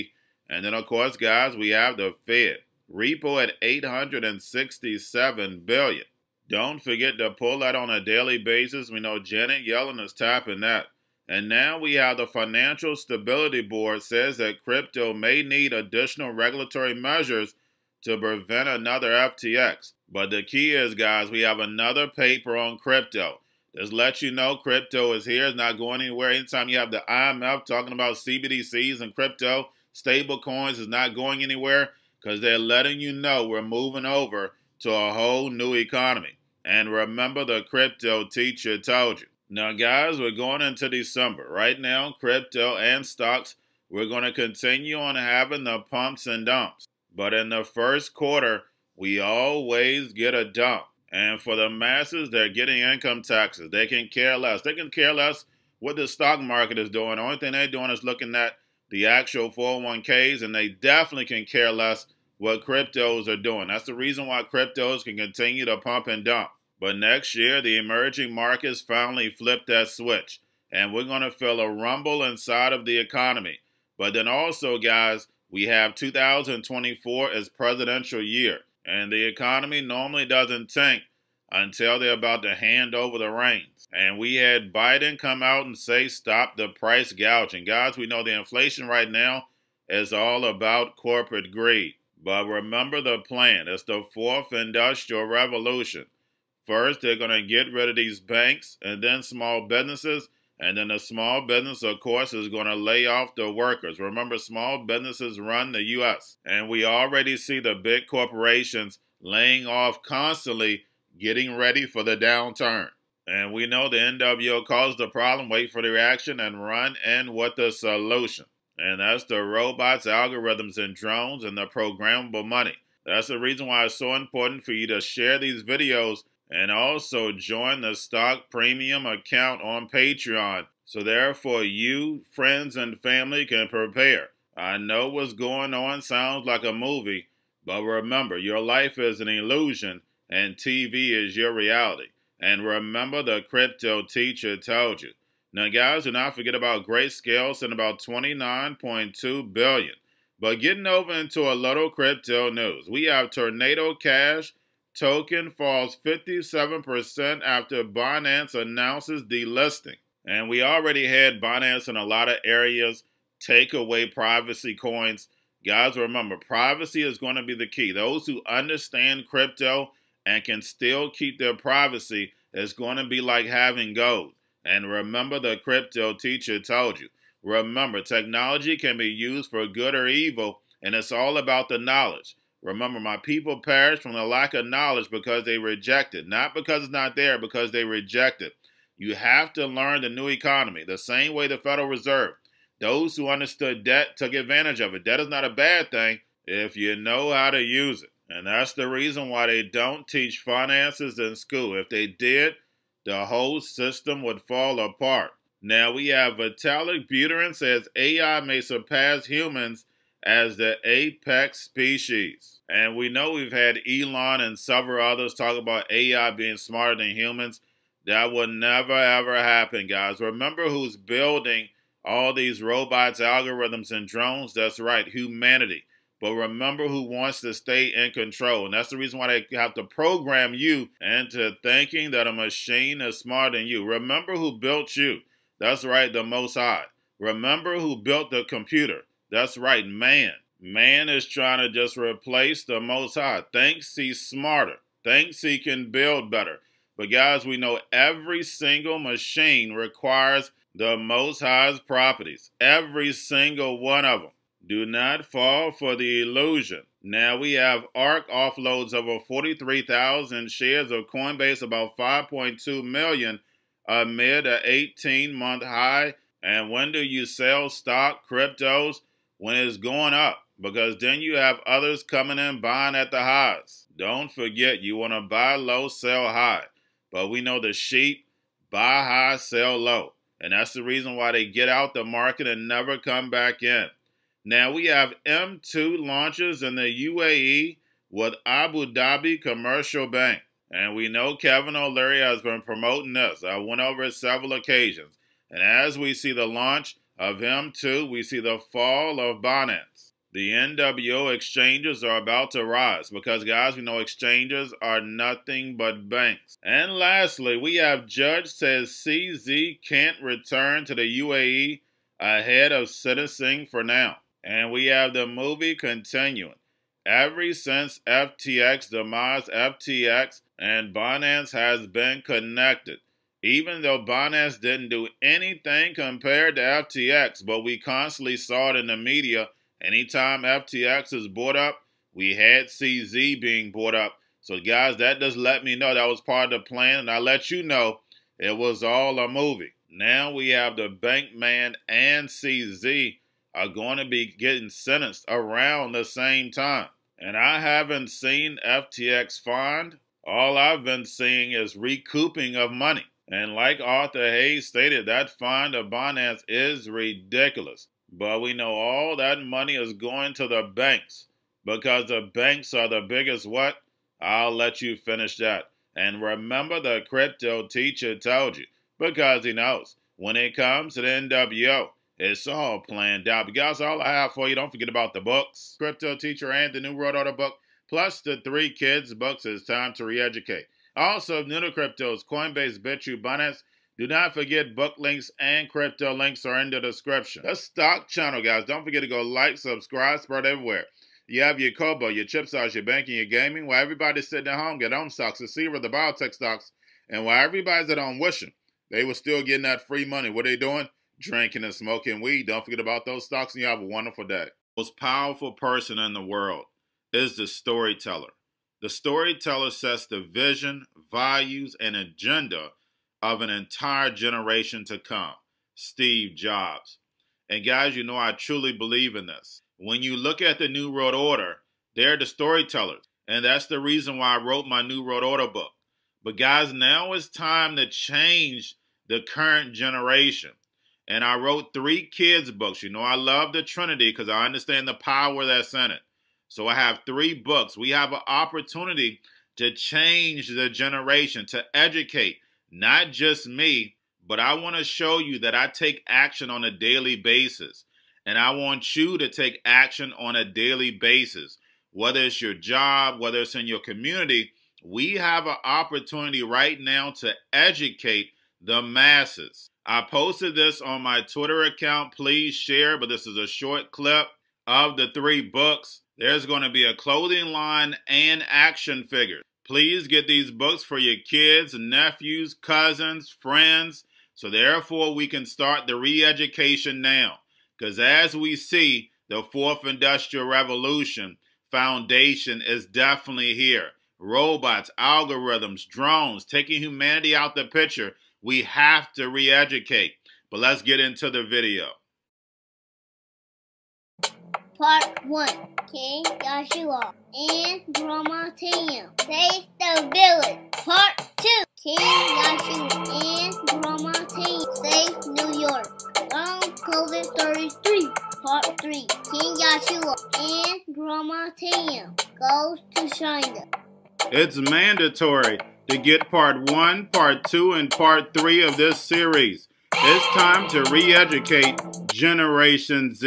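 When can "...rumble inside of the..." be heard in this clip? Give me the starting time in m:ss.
1:11.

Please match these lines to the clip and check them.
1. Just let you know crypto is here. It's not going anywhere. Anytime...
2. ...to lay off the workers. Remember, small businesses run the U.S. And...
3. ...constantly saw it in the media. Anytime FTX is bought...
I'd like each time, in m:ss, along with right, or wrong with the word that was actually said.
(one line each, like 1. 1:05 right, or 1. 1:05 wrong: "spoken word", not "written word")
1. 0:23 right
2. 1:42 right
3. 5:27 right.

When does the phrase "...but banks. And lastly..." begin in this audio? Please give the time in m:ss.
5:05.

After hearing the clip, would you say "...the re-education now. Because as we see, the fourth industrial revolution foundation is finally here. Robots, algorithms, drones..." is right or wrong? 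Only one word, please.
wrong.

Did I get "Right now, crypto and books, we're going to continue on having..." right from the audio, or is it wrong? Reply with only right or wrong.
wrong.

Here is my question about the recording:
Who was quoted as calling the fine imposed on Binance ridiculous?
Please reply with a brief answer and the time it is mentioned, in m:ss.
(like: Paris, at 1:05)
Arthur Hayes, at 5:53.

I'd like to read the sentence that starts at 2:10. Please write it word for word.
So therefore you, friends, and family can prepare.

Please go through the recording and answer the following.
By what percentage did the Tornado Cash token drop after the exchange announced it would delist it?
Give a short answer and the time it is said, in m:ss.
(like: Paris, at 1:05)
57%, at 2:36.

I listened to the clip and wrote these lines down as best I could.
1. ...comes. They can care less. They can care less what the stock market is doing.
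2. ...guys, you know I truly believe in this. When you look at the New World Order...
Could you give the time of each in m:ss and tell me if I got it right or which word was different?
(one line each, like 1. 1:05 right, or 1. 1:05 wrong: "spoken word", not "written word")
1. 0:53 wrong: "taxes", not "comes"
2. 6:57 right.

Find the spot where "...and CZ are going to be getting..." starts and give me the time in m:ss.
5:41.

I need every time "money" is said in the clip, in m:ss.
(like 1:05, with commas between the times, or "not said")
2:02, 5:52, 5:59, 6:40.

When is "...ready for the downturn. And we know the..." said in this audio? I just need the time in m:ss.
1:51.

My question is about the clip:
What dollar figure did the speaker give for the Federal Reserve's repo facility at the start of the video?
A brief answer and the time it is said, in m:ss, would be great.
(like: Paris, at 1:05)
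867 billion, at 0:03.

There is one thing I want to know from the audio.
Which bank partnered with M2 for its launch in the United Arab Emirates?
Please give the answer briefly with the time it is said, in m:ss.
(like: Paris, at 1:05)
Abu Dhabi Commercial Bank, at 4:48.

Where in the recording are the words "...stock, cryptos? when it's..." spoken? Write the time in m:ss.
4:27.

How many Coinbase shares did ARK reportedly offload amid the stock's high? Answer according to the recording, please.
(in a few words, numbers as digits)
43,000.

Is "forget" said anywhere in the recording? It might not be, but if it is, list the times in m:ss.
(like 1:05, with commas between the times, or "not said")
0:06, 2:26, 4:34, 6:14, 6:24, 6:28, 6:42.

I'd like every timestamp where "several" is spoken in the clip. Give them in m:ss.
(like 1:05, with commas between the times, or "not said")
3:34, 4:54.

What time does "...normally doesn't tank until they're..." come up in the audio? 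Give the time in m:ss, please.
1:19.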